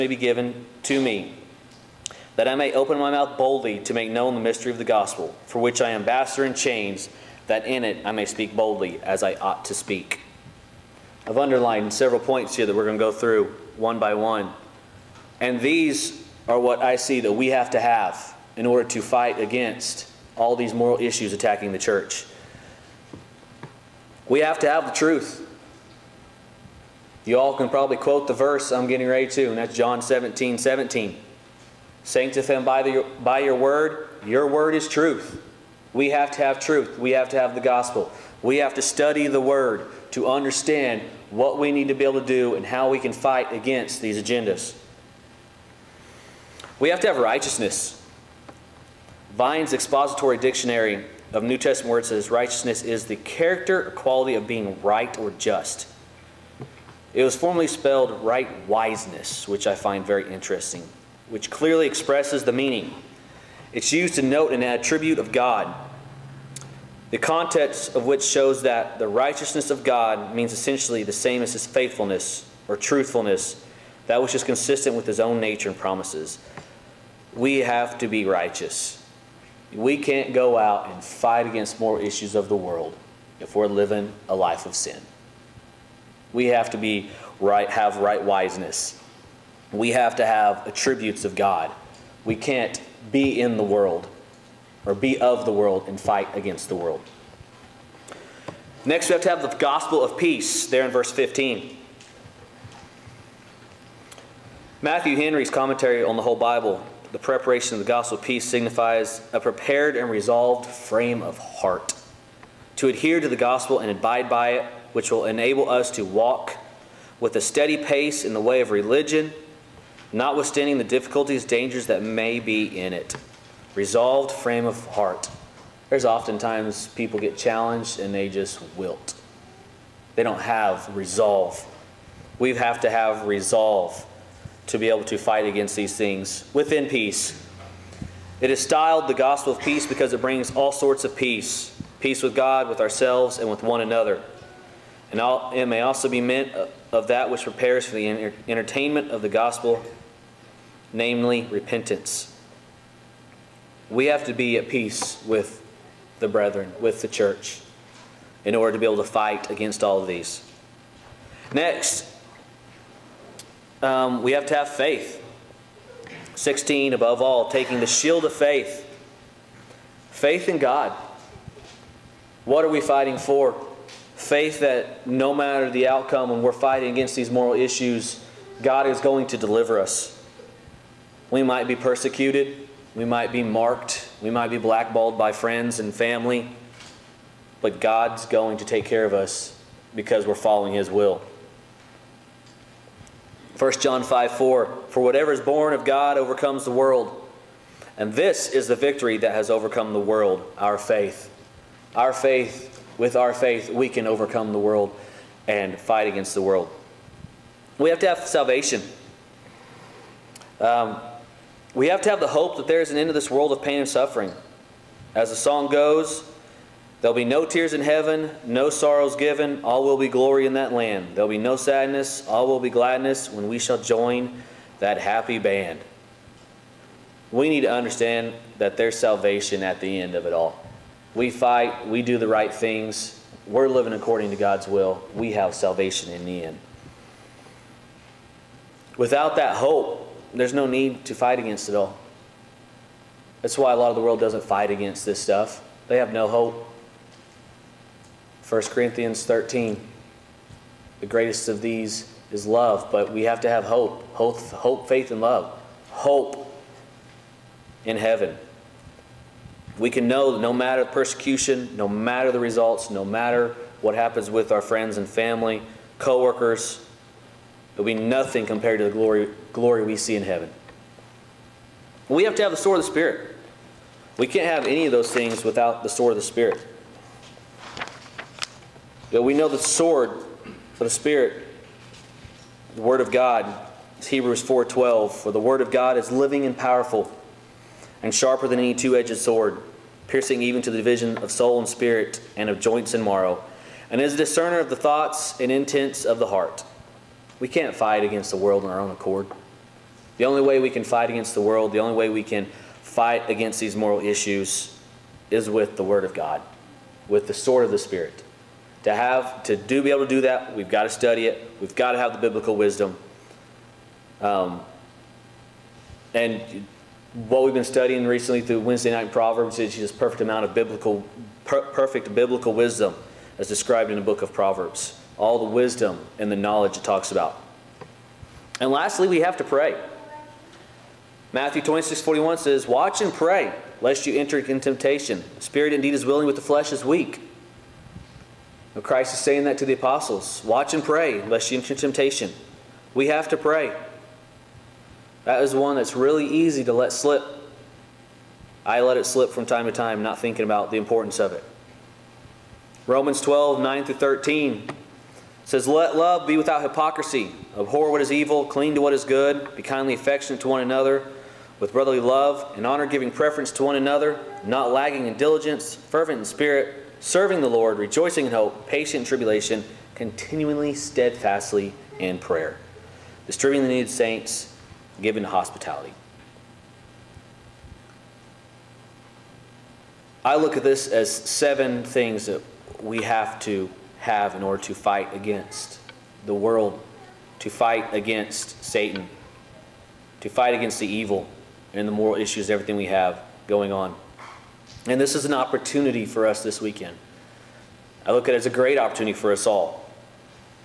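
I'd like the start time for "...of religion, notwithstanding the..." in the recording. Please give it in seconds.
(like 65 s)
118 s.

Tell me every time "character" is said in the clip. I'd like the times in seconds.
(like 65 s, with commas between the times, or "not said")
53 s.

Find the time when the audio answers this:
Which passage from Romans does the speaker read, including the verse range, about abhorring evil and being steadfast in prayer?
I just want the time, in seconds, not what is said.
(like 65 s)
352 s.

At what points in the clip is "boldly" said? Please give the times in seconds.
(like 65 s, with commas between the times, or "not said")
3 s, 8 s.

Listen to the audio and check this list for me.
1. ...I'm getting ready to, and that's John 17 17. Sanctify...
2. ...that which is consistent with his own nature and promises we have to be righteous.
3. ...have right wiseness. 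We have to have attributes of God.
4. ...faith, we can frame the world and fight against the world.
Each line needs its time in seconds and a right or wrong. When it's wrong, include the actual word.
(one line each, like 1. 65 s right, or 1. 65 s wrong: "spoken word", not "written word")
1. 28 s right
2. 74 s right
3. 87 s right
4. 203 s wrong: "overcome", not "frame".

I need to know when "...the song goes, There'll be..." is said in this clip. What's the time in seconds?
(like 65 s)
215 s.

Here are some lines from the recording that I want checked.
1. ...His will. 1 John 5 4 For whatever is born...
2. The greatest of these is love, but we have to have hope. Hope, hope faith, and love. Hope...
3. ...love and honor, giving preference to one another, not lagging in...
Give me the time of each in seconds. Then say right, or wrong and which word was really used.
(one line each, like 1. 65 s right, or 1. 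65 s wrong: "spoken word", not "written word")
1. 190 s right
2. 250 s right
3. 361 s right.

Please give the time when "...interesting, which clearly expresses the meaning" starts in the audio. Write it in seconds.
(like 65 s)
60 s.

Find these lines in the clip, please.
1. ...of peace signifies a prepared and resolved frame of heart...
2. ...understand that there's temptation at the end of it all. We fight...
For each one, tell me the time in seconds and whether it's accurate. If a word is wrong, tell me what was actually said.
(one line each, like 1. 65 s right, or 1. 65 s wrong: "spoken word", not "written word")
1. 108 s right
2. 227 s wrong: "salvation", not "temptation".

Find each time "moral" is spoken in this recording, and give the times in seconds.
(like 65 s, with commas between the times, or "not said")
20 s, 177 s, 303 s, 391 s.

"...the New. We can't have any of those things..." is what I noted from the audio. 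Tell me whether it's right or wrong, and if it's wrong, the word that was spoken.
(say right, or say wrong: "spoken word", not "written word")
wrong: "Spirit", not "New".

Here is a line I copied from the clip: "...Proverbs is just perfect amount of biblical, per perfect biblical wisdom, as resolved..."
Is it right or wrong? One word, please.
wrong.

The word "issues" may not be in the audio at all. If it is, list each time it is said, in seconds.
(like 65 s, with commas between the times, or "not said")
20 s, 81 s, 177 s, 303 s, 392 s.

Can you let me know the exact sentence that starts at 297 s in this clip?
We can't fight against the world on our own accord.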